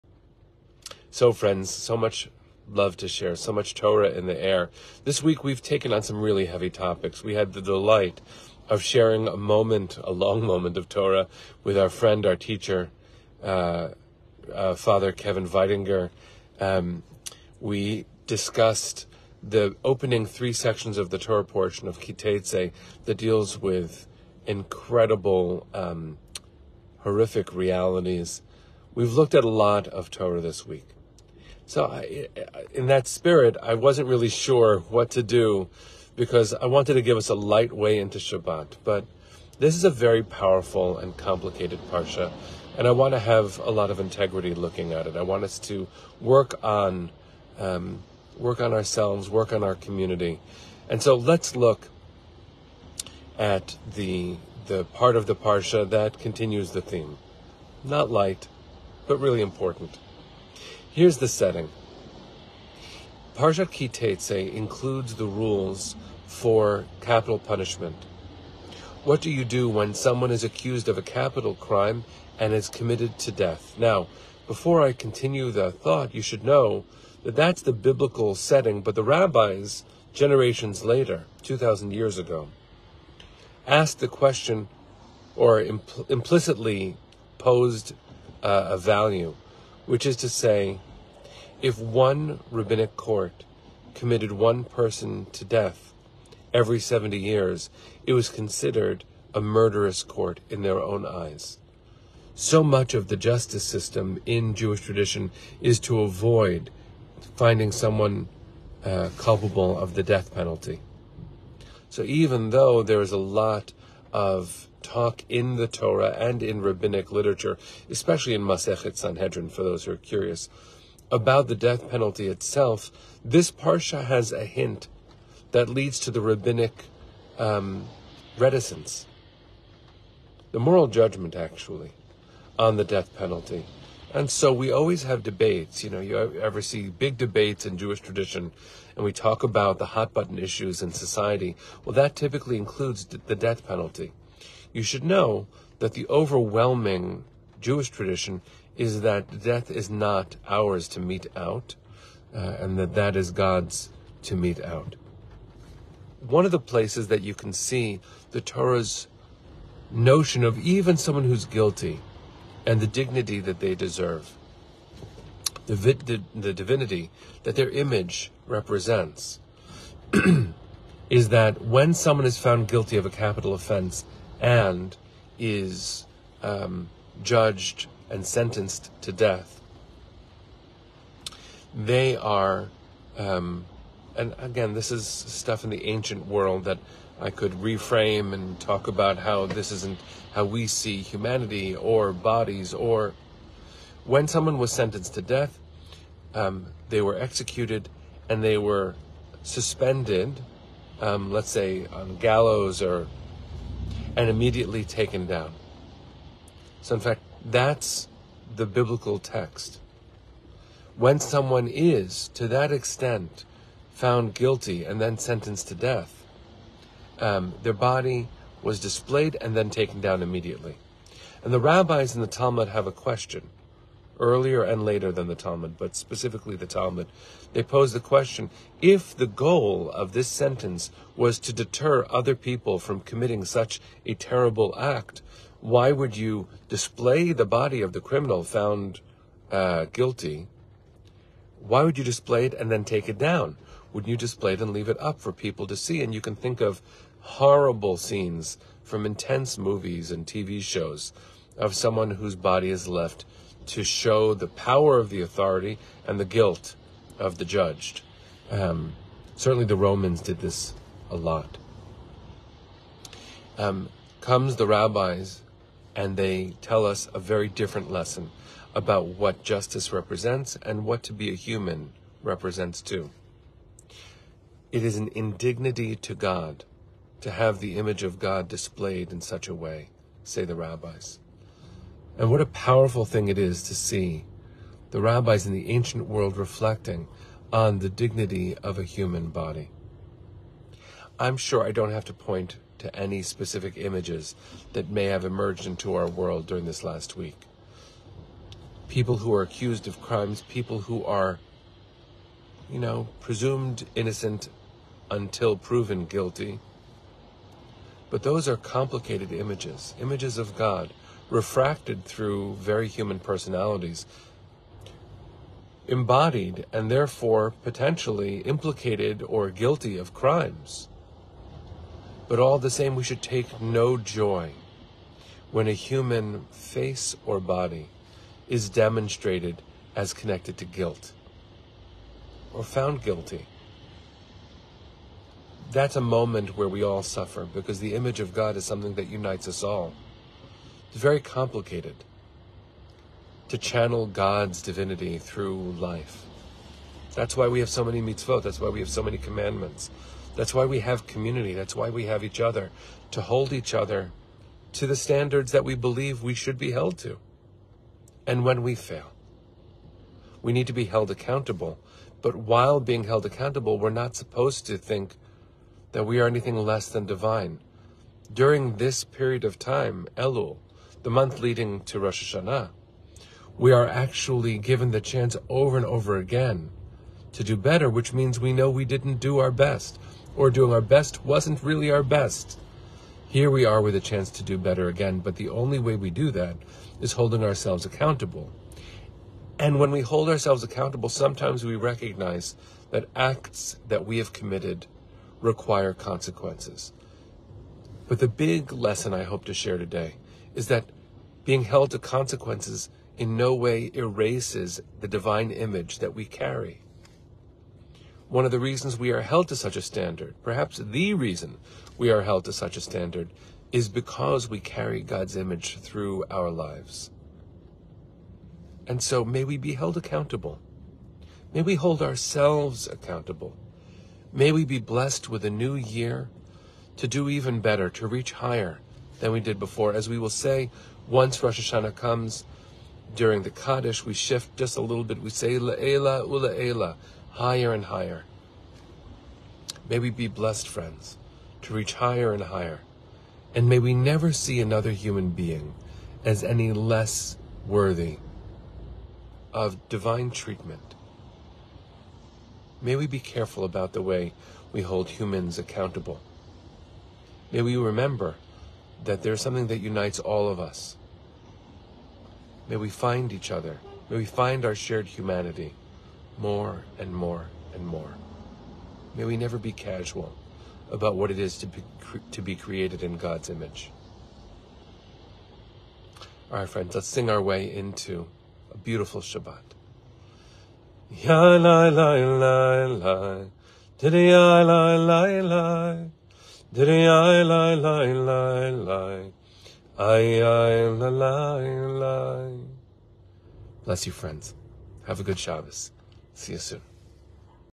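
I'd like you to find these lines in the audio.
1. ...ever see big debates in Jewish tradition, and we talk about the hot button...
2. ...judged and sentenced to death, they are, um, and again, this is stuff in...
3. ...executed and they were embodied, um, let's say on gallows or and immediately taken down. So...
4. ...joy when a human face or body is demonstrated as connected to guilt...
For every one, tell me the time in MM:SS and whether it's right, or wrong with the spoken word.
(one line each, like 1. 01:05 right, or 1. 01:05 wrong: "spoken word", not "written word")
1. 02:16 right
2. 02:57 right
3. 03:17 wrong: "suspended", not "embodied"
4. 05:23 right.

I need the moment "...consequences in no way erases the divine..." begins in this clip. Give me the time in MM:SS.
06:41.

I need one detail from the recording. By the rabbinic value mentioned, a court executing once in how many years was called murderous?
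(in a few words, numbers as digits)
70.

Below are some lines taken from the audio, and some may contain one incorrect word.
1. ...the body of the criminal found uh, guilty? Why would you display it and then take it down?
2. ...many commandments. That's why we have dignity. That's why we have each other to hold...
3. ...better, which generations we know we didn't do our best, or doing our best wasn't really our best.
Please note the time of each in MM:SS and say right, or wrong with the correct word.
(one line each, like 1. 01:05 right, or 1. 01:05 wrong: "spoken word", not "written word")
1. 03:57 right
2. 05:49 wrong: "community", not "dignity"
3. 06:17 wrong: "means", not "generations".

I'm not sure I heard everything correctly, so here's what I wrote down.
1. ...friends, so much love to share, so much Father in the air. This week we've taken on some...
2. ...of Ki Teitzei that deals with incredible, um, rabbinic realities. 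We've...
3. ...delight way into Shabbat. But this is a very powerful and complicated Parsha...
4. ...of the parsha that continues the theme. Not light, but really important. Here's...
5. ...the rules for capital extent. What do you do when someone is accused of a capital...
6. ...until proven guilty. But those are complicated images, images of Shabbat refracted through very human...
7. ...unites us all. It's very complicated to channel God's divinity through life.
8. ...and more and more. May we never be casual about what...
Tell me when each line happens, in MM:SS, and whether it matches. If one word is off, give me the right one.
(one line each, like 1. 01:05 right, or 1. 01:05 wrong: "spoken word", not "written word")
1. 00:01 wrong: "Torah", not "Father"
2. 00:21 wrong: "horrific", not "rabbinic"
3. 00:37 wrong: "light", not "delight"
4. 00:55 right
5. 01:05 wrong: "punishment", not "extent"
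6. 05:05 wrong: "God", not "Shabbat"
7. 05:39 right
8. 07:46 right.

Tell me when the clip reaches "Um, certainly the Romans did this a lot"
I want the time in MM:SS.
04:18.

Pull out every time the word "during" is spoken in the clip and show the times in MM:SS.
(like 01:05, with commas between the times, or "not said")
04:56, 06:08, 07:13.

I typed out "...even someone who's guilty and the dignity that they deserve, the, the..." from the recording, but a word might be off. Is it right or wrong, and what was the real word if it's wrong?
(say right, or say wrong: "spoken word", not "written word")
right.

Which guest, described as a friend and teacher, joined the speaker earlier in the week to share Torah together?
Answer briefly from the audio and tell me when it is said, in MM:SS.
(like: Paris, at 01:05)
Father Kevin Weidinger, at 00:14.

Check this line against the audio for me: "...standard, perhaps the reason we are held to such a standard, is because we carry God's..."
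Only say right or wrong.
right.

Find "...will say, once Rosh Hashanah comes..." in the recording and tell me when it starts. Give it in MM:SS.
07:10.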